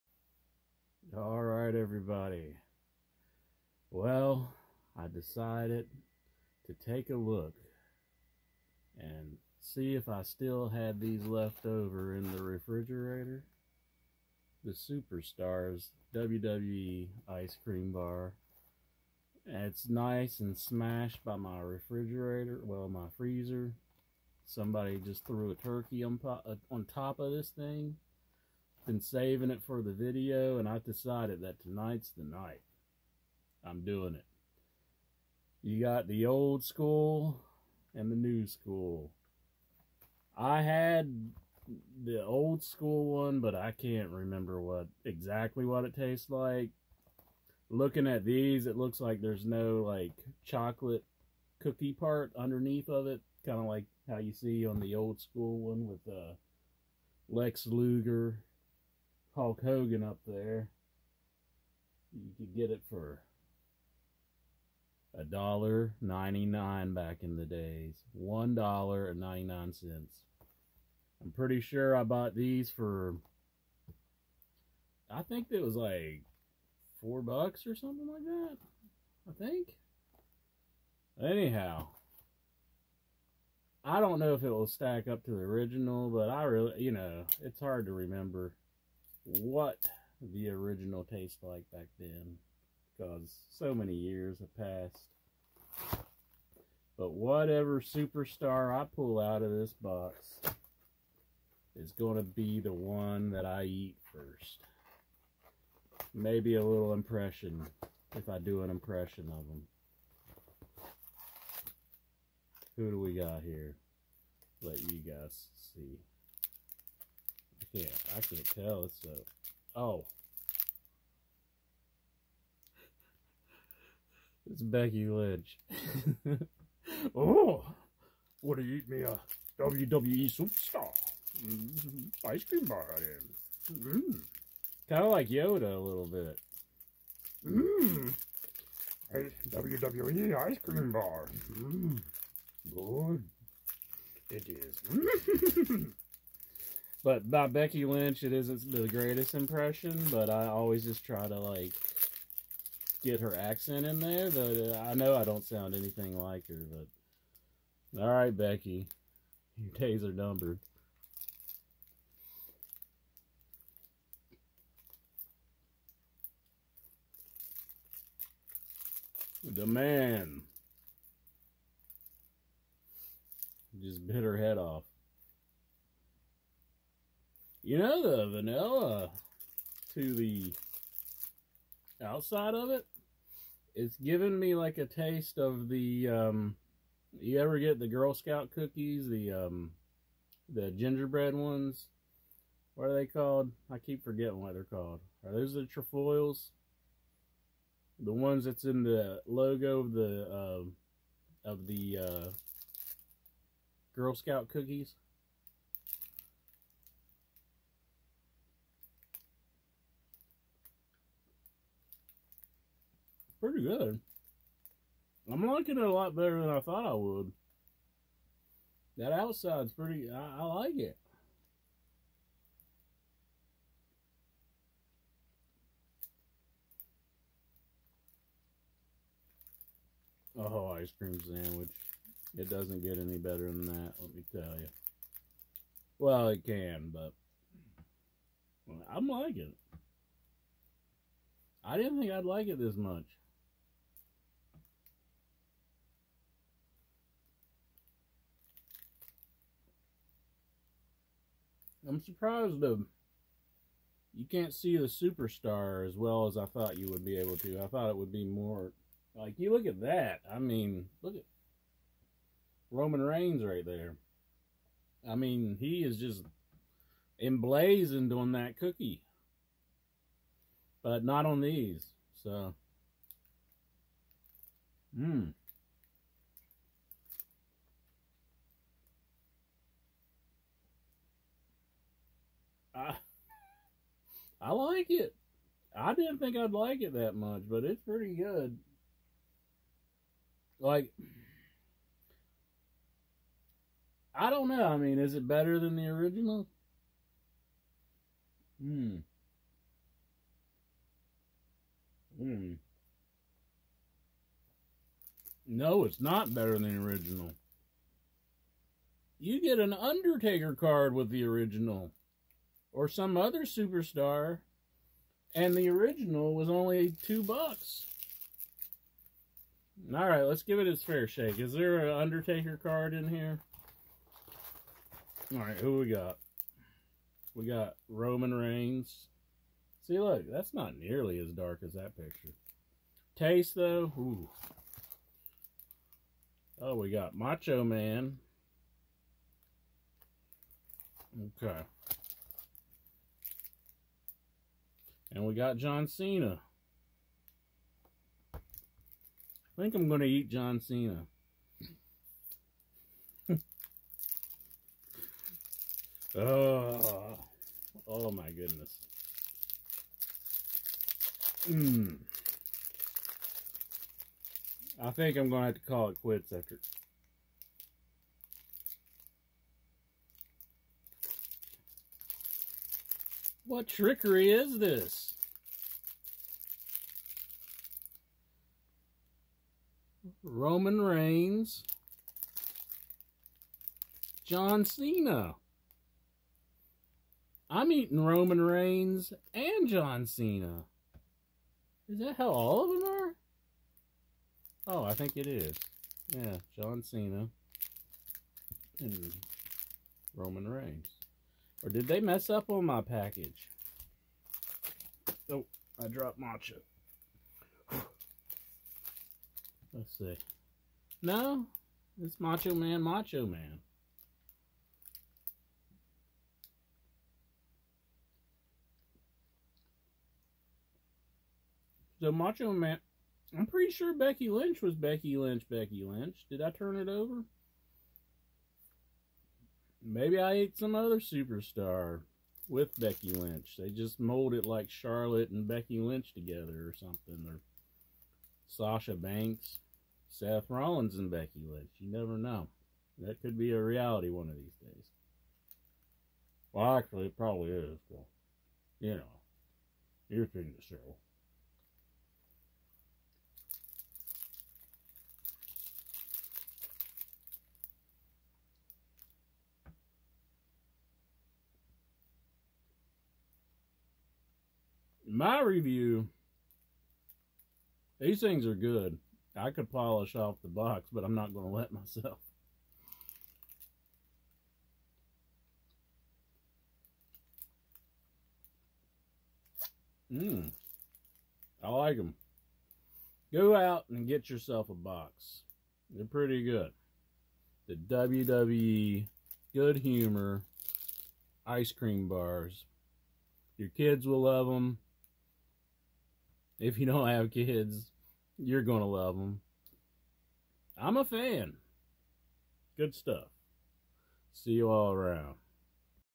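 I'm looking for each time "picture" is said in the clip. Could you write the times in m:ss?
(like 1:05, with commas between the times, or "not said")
5:31.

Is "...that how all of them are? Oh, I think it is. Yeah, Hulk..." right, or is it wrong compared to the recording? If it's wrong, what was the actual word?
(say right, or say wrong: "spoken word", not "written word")
wrong: "John", not "Hulk".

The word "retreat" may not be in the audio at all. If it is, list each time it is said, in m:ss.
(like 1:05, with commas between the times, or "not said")
not said.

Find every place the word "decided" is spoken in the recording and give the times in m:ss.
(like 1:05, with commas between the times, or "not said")
0:05, 0:30.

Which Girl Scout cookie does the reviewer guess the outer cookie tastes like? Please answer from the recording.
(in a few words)
Trefoils.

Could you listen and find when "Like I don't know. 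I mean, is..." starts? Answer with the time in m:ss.
4:50.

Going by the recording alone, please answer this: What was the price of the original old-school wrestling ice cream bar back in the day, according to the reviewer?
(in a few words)
$1.99.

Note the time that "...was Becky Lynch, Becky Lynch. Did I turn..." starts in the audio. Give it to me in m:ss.
7:04.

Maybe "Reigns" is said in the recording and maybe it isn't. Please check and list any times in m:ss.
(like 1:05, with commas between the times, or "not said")
4:23, 5:28, 6:20, 6:28, 6:40.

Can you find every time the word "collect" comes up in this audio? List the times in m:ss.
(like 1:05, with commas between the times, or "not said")
not said.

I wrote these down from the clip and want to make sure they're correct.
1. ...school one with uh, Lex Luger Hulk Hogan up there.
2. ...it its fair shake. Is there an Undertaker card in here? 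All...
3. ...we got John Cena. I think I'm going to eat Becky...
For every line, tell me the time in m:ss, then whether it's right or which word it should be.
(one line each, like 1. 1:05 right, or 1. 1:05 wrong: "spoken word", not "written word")
1. 0:55 right
2. 5:20 right
3. 5:45 wrong: "John", not "Becky".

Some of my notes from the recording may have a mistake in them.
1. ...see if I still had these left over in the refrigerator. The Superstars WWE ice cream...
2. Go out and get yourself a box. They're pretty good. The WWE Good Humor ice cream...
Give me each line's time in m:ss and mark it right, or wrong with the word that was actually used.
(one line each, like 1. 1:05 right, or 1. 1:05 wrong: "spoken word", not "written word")
1. 0:09 right
2. 8:03 right.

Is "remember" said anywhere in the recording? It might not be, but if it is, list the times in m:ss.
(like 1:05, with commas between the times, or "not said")
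0:44, 1:27.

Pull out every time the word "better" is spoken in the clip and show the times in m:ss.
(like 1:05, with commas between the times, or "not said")
3:36, 3:53, 4:55, 5:06.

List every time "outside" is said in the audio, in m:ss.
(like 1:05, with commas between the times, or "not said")
3:02, 3:39.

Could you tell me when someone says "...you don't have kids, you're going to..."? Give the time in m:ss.
8:16.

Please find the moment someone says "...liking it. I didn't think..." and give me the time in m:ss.
3:59.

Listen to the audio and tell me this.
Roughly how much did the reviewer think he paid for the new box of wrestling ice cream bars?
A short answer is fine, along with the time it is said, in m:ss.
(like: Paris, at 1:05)
4 bucks, at 1:17.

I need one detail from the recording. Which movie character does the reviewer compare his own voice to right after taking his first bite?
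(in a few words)
Yoda.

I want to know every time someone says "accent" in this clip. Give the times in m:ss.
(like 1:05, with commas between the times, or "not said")
2:33.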